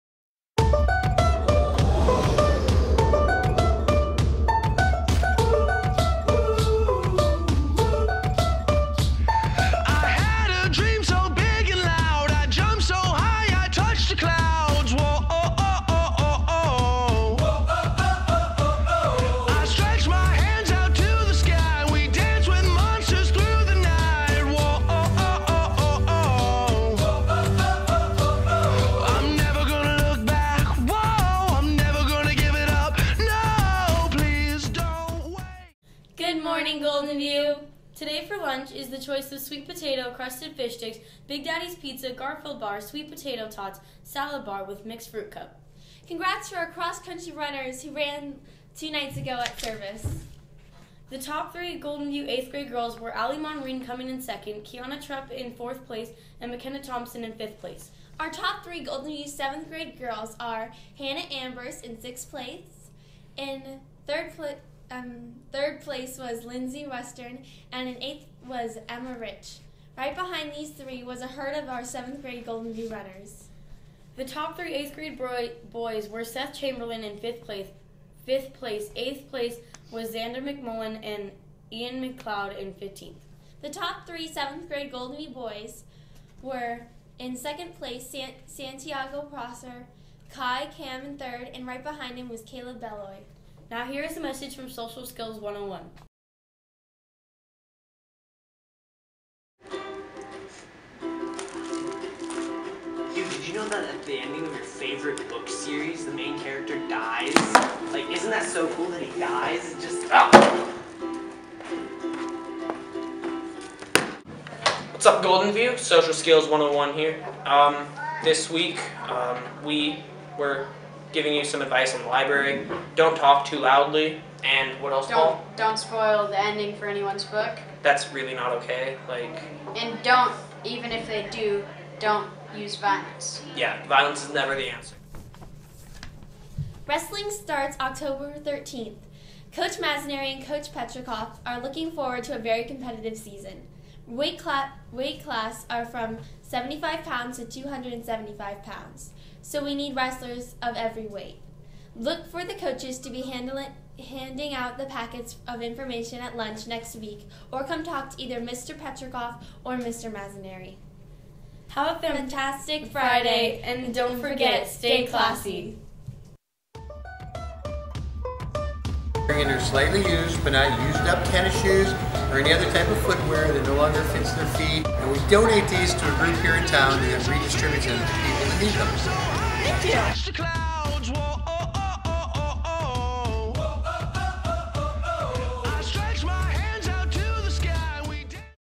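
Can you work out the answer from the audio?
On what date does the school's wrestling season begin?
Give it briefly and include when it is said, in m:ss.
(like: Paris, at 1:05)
October 13, at 2:17.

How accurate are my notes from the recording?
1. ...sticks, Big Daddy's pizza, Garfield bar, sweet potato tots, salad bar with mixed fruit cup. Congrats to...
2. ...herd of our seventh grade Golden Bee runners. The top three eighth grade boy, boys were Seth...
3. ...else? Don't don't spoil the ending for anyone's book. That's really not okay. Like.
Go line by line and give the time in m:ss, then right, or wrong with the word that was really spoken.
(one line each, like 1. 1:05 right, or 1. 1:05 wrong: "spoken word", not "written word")
1. 0:40 right
2. 1:11 right
3. 2:04 right.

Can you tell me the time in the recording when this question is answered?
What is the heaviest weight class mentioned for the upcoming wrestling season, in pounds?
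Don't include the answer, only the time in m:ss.
2:27.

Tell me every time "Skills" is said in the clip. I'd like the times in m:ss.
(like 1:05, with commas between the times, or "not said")
1:35, 1:56.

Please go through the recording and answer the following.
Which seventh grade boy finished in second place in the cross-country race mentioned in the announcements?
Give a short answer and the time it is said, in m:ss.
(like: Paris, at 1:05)
Santiago Prosser, at 1:28.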